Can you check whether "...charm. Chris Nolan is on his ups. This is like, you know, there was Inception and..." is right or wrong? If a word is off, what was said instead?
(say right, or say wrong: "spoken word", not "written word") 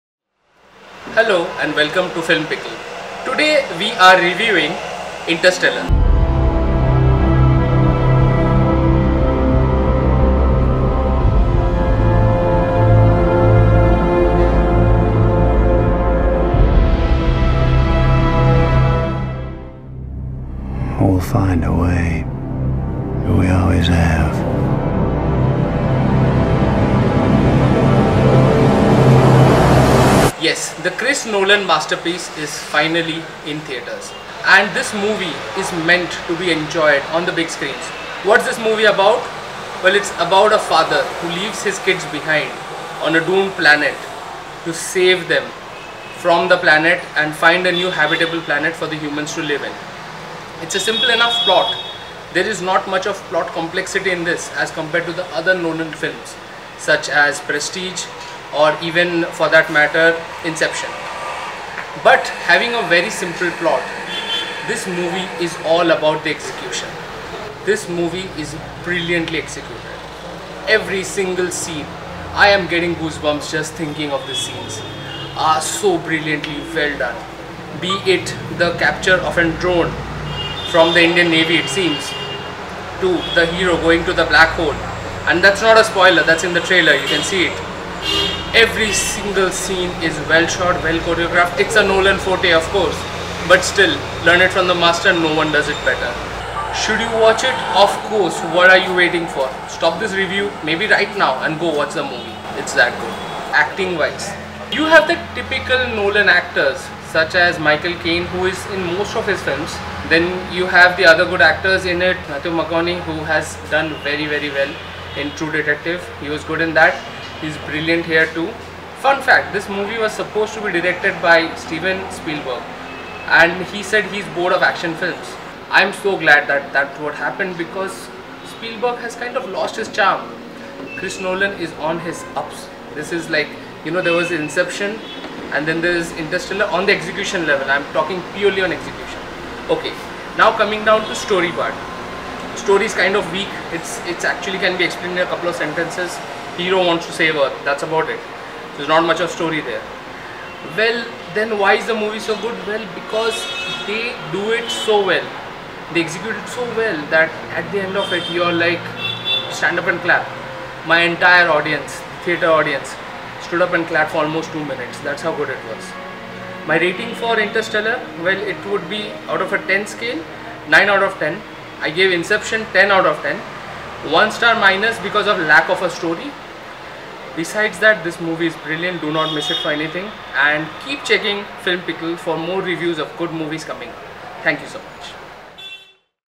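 right.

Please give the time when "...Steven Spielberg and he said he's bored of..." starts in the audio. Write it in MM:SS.
02:01.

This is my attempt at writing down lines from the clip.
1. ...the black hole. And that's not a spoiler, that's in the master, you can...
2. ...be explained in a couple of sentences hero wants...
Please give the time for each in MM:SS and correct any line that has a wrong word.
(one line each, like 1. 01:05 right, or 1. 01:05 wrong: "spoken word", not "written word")
1. 01:24 wrong: "trailer", not "master"
2. 02:24 right.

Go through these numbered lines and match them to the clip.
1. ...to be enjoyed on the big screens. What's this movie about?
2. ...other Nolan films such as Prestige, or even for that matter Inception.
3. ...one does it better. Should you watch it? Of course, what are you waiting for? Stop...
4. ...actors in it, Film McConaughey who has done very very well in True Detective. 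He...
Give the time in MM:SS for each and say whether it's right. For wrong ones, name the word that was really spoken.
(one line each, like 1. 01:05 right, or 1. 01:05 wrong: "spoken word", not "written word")
1. 00:36 right
2. 00:55 right
3. 01:35 right
4. 01:51 wrong: "Matthew", not "Film".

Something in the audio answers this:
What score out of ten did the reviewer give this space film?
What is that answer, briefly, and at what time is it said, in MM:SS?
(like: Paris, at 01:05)
9, at 02:50.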